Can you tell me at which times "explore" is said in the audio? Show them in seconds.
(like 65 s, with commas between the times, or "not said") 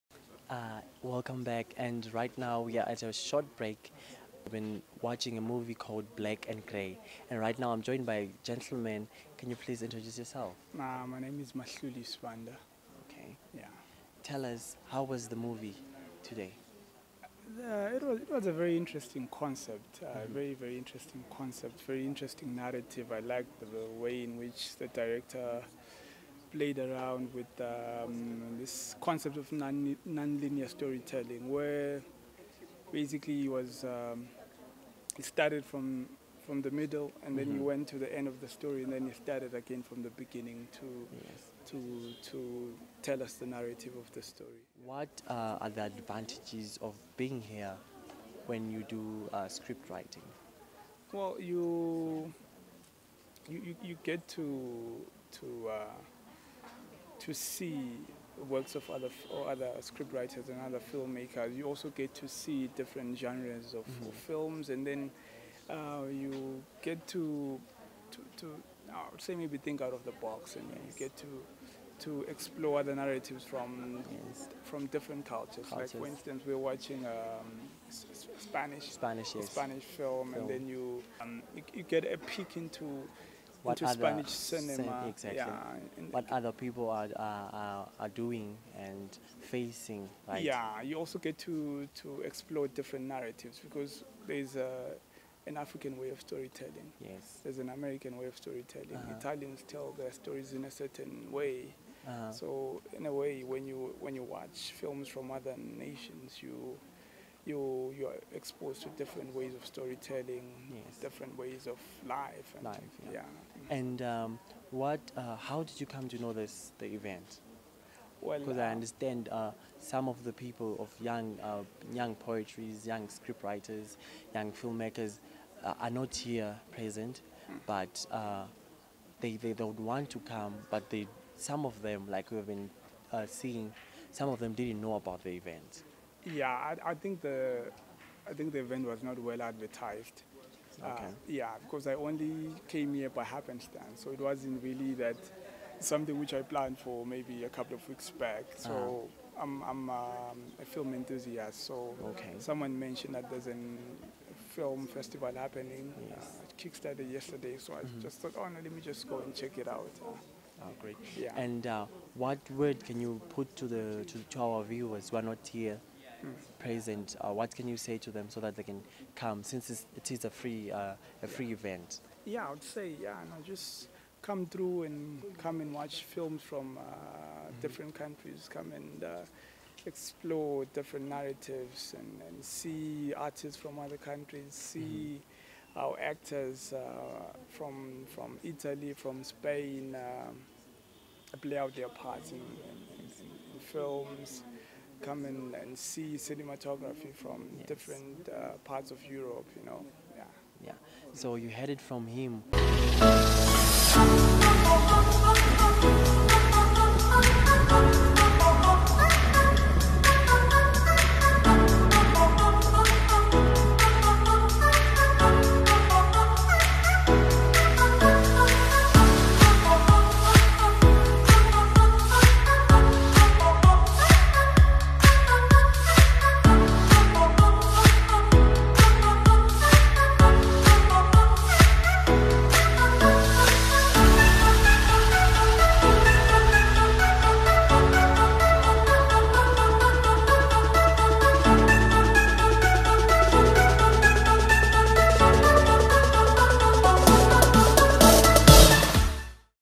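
72 s, 92 s, 179 s.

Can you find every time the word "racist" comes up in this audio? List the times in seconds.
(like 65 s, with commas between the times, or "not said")
not said.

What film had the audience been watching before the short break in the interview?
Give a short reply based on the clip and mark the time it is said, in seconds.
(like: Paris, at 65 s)
Black and Grey, at 6 s.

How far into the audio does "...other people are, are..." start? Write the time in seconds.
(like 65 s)
86 s.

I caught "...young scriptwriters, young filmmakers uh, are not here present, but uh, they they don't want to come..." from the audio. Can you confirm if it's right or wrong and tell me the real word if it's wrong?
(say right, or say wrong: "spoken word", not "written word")
right.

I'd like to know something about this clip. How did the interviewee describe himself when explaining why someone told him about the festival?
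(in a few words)
a film enthusiast.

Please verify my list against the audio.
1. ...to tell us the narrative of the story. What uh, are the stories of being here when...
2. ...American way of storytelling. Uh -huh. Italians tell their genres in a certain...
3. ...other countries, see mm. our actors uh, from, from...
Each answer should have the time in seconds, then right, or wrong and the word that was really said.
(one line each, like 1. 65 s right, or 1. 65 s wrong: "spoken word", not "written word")
1. 42 s wrong: "advantages", not "stories"
2. 97 s wrong: "stories", not "genres"
3. 183 s right.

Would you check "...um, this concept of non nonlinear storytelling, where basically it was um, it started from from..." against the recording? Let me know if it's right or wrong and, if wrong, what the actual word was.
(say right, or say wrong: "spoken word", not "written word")
right.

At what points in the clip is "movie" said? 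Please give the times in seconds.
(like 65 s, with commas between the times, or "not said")
5 s, 15 s.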